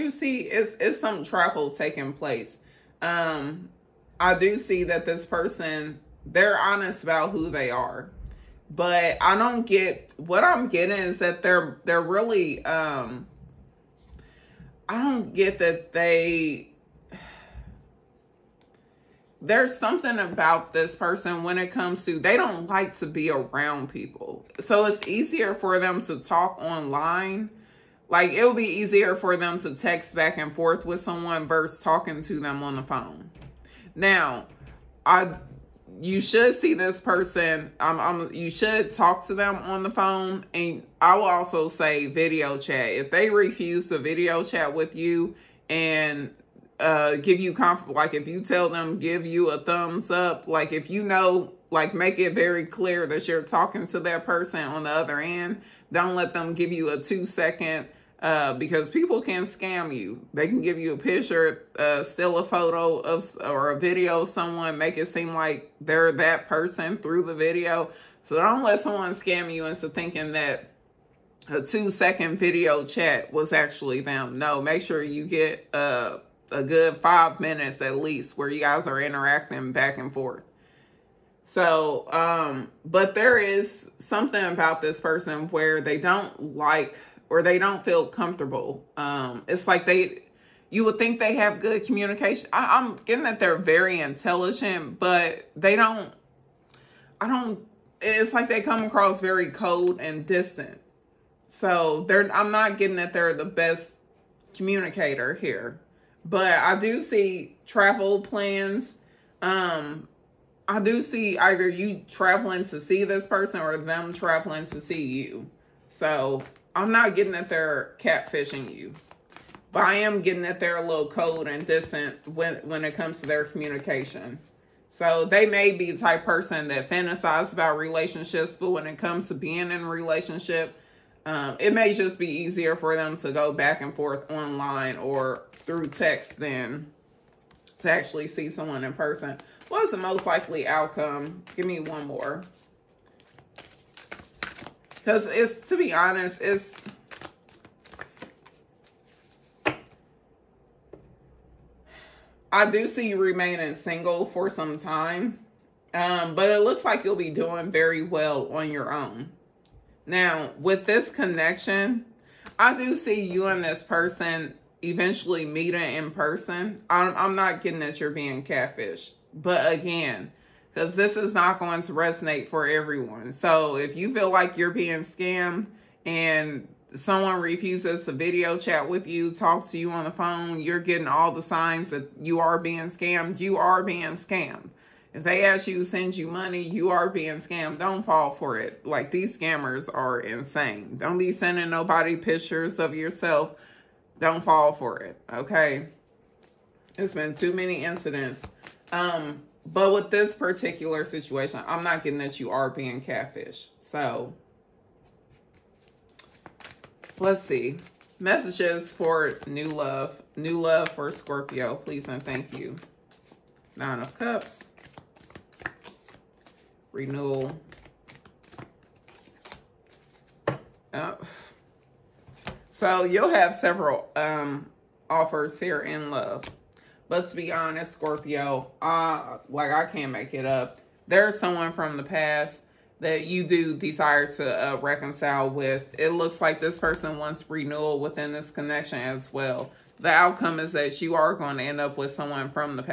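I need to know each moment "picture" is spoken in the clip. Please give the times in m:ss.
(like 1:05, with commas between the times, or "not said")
1:00, 3:12.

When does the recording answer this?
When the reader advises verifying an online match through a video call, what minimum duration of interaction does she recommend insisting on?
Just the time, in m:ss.
1:16.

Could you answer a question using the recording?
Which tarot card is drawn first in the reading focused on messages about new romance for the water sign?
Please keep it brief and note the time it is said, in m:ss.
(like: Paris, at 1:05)
Nine of Cups, at 3:33.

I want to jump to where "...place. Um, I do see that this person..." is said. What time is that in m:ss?
0:02.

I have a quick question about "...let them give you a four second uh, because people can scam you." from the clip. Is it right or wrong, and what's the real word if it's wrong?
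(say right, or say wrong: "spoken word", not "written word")
wrong: "two", not "four".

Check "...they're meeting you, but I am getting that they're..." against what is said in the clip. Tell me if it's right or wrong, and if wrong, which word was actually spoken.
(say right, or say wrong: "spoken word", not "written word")
wrong: "catfishing", not "meeting".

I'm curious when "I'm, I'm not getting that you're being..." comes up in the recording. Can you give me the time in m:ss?
2:46.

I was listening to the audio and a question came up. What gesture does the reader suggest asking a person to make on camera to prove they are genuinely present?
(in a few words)
thumbs up.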